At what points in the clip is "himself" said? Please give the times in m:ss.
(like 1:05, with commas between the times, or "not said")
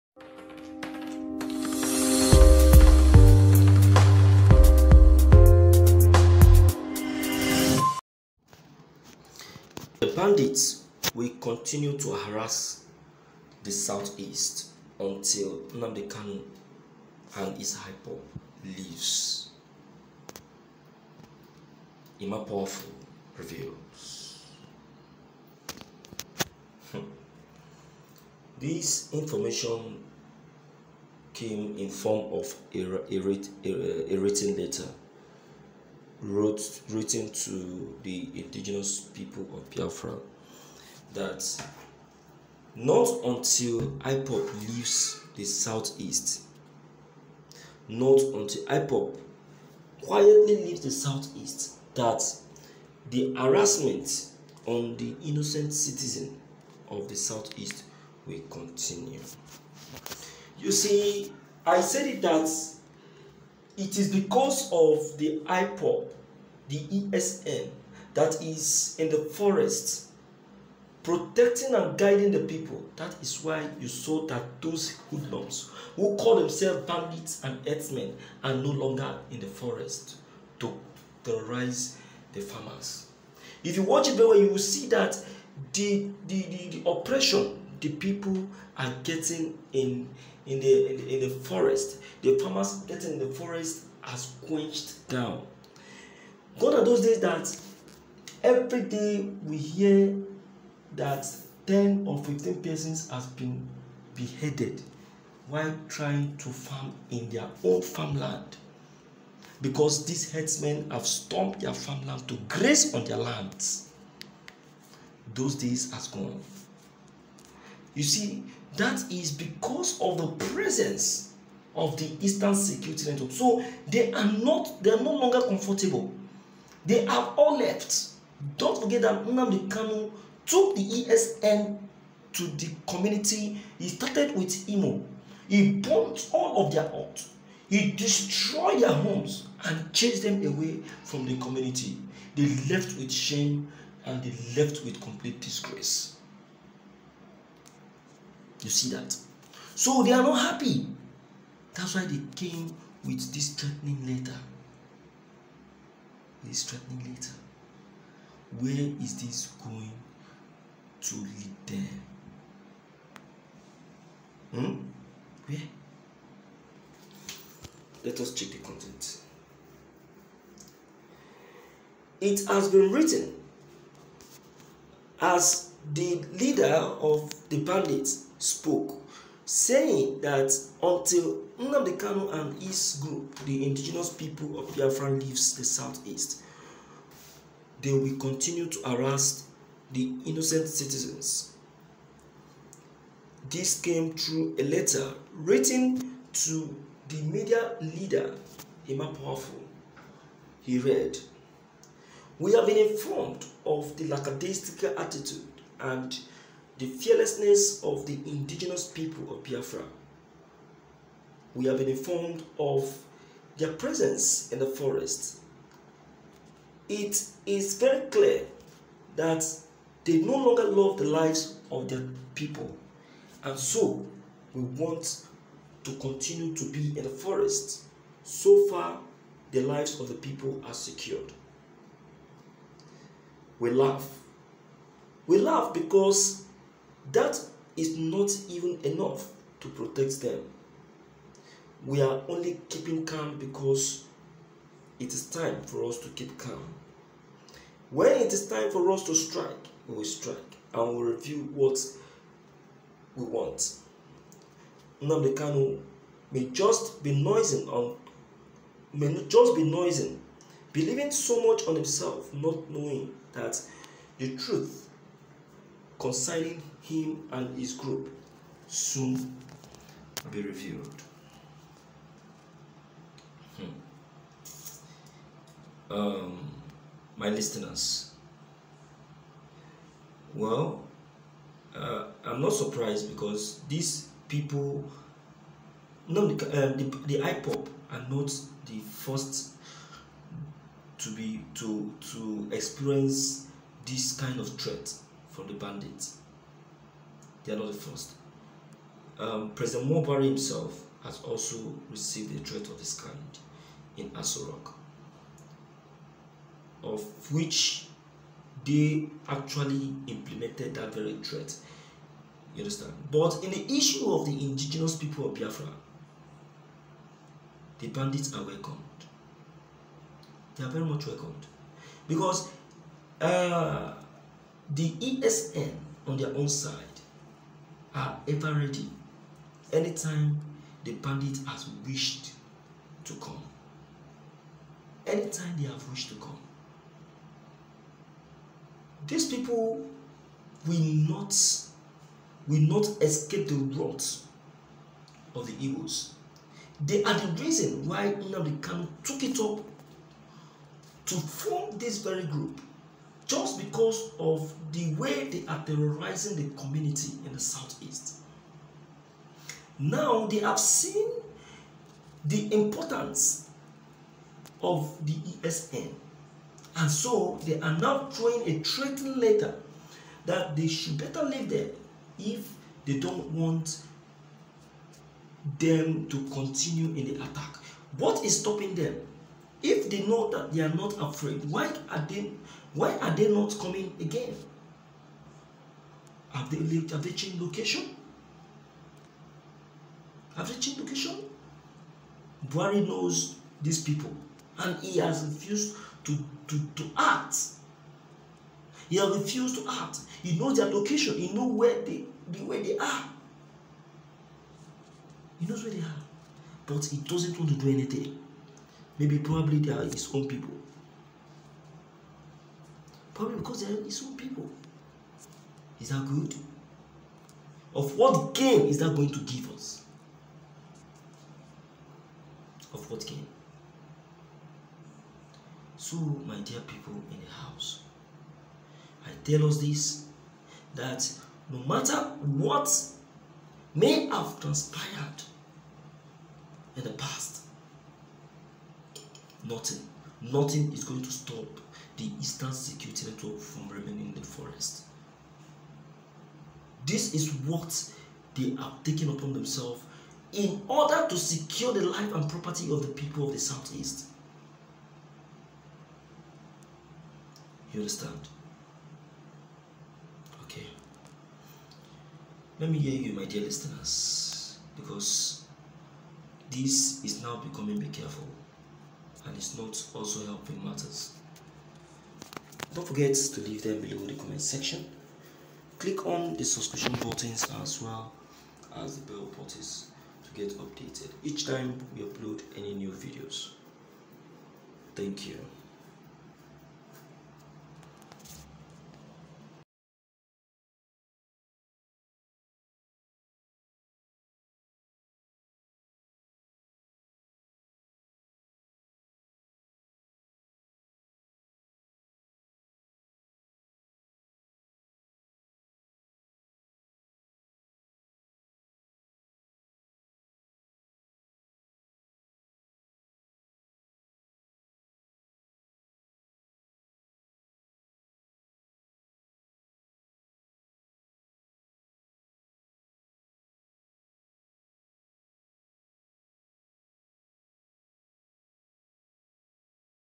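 4:21, 5:00.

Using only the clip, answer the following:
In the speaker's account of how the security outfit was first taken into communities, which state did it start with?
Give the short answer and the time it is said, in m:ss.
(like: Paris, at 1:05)
Imo, at 2:14.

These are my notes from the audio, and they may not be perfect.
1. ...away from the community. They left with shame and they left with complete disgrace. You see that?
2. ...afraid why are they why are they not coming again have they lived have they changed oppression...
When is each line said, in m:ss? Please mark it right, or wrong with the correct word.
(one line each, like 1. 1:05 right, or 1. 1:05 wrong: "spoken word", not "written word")
1. 2:20 right
2. 6:20 wrong: "location", not "oppression".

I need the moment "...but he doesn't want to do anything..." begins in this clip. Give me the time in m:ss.
6:46.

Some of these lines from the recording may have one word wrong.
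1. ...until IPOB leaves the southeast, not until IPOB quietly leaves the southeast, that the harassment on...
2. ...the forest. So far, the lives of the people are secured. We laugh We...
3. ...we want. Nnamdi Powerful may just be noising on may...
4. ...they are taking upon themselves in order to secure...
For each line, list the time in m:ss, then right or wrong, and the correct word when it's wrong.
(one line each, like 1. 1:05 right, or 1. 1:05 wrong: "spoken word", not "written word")
1. 0:43 right
2. 3:47 right
3. 4:13 wrong: "Kanu", not "Powerful"
4. 7:28 right.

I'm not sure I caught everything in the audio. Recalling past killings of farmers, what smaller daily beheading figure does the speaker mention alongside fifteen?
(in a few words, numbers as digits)
10.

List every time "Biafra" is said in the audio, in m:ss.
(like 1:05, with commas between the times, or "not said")
0:39, 3:04, 3:29, 5:15.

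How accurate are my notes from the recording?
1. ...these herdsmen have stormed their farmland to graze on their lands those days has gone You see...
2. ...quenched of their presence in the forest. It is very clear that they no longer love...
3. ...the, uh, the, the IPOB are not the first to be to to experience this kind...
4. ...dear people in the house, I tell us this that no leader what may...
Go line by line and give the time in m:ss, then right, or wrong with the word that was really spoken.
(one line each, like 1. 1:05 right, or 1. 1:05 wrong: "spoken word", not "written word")
1. 1:50 right
2. 3:31 wrong: "informed", not "quenched"
3. 4:46 right
4. 7:06 wrong: "matter", not "leader".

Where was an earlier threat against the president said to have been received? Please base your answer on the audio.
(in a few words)
Aso Rock.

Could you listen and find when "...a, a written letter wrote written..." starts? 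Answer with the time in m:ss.
0:33.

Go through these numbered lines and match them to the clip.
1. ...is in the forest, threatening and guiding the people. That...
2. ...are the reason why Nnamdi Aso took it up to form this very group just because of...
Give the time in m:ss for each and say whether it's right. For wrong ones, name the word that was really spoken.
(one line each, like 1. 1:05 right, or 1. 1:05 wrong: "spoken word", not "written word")
1. 1:08 wrong: "protecting", not "threatening"
2. 5:47 wrong: "Kanu", not "Aso".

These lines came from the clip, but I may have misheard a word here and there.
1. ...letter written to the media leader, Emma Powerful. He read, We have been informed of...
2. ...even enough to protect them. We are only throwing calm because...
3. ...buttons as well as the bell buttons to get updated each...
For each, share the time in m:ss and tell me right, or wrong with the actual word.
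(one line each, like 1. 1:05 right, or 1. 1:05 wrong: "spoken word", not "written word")
1. 3:14 right
2. 3:58 wrong: "keeping", not "throwing"
3. 7:56 right.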